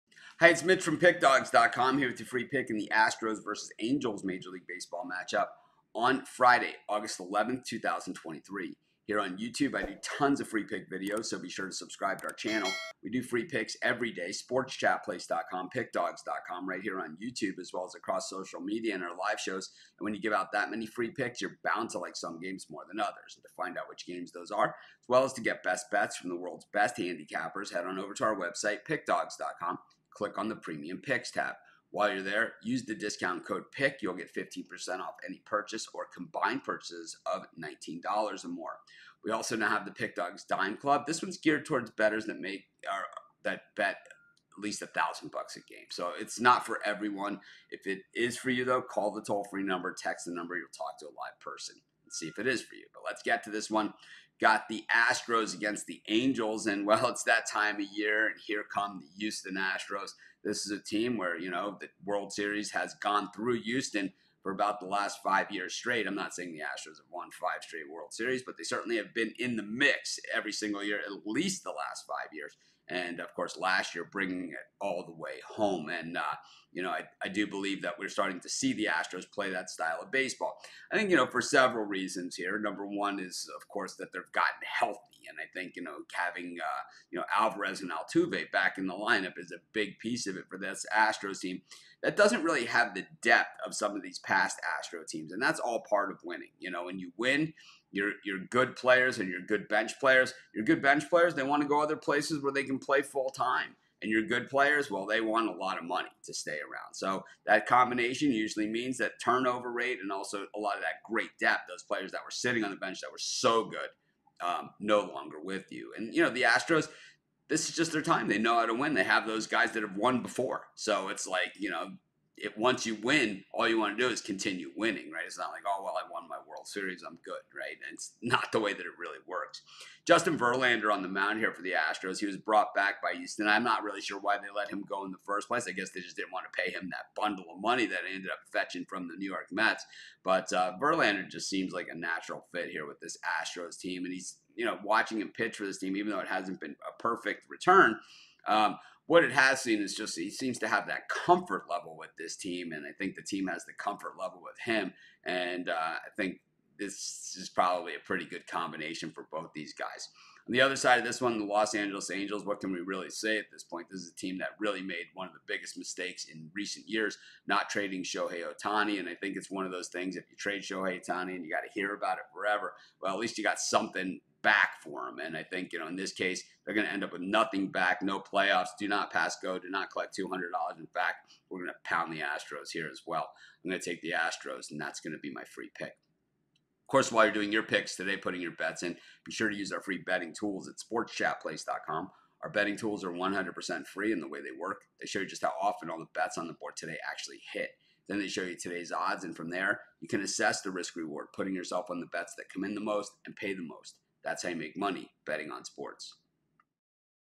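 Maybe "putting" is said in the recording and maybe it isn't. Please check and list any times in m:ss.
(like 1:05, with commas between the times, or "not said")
3:08, 3:21.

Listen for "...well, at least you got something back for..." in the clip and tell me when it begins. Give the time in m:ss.
2:53.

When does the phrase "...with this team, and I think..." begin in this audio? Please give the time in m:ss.
2:31.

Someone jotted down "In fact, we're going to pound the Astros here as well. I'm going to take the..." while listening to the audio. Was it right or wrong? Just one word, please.
right.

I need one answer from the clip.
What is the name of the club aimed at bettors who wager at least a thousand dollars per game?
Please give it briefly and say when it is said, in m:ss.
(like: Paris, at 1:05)
Pick Dawgz Dime Club, at 0:39.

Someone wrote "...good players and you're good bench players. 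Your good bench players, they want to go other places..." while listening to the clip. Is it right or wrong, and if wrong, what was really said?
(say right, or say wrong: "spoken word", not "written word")
right.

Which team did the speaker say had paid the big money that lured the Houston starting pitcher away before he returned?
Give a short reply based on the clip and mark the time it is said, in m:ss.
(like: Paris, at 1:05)
New York Mets, at 2:19.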